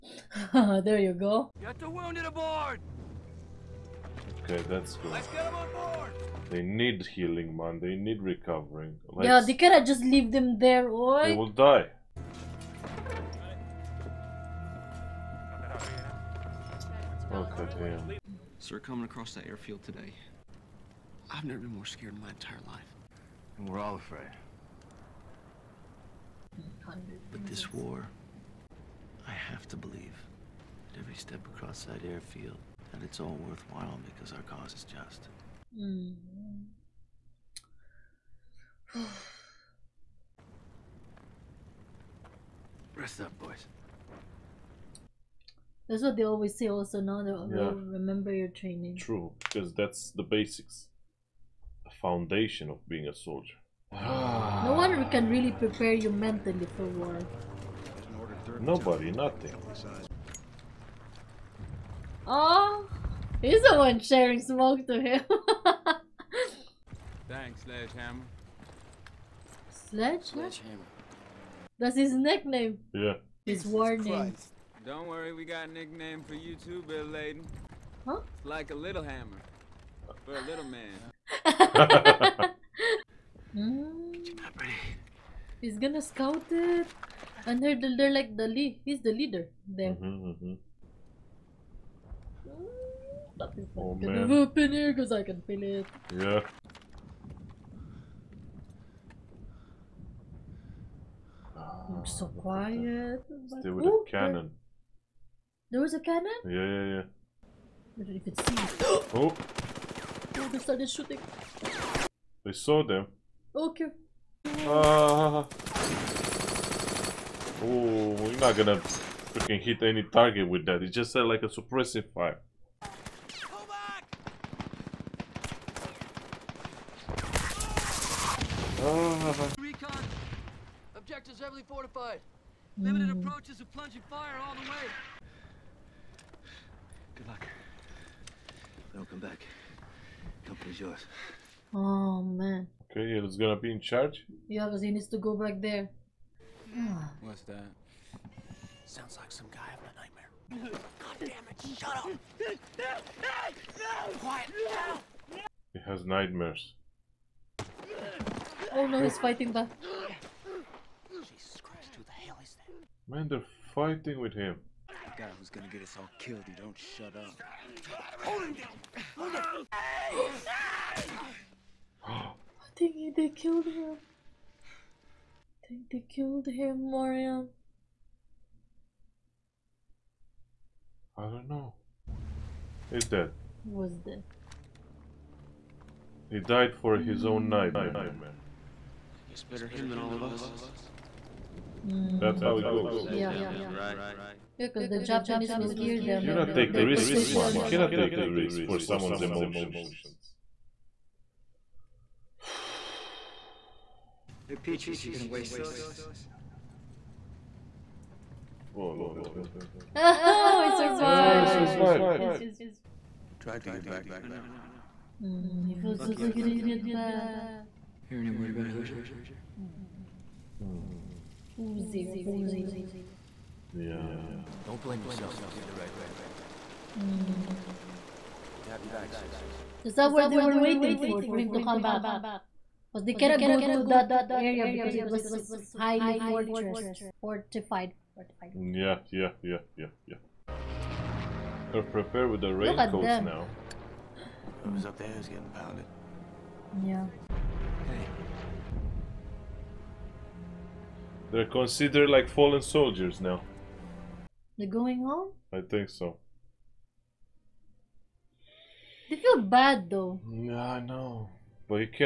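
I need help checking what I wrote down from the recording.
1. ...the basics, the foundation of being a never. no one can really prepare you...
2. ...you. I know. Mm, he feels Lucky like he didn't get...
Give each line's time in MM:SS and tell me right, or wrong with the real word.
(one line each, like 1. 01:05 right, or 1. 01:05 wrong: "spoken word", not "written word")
1. 00:50 wrong: "soldier", not "never"
2. 03:34 right.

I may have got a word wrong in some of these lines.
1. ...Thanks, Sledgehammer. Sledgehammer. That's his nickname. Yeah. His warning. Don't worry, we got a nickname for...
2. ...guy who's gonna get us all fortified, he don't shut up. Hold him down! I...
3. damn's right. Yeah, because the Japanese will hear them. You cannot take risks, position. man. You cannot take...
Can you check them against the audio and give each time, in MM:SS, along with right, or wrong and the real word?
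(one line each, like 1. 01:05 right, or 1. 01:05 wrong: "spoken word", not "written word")
1. 01:07 right
2. 02:45 wrong: "killed", not "fortified"
3. 03:13 right.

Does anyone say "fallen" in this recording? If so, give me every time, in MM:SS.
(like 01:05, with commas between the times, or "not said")
04:12.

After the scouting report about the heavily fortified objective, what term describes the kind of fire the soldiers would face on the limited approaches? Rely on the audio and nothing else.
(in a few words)
plunging fire.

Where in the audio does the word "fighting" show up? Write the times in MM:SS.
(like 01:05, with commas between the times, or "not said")
02:39, 02:43.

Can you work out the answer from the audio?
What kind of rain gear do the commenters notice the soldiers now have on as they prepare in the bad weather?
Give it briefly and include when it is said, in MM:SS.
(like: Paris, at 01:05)
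raincoats, at 04:02.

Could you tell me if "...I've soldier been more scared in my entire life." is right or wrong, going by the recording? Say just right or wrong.
wrong.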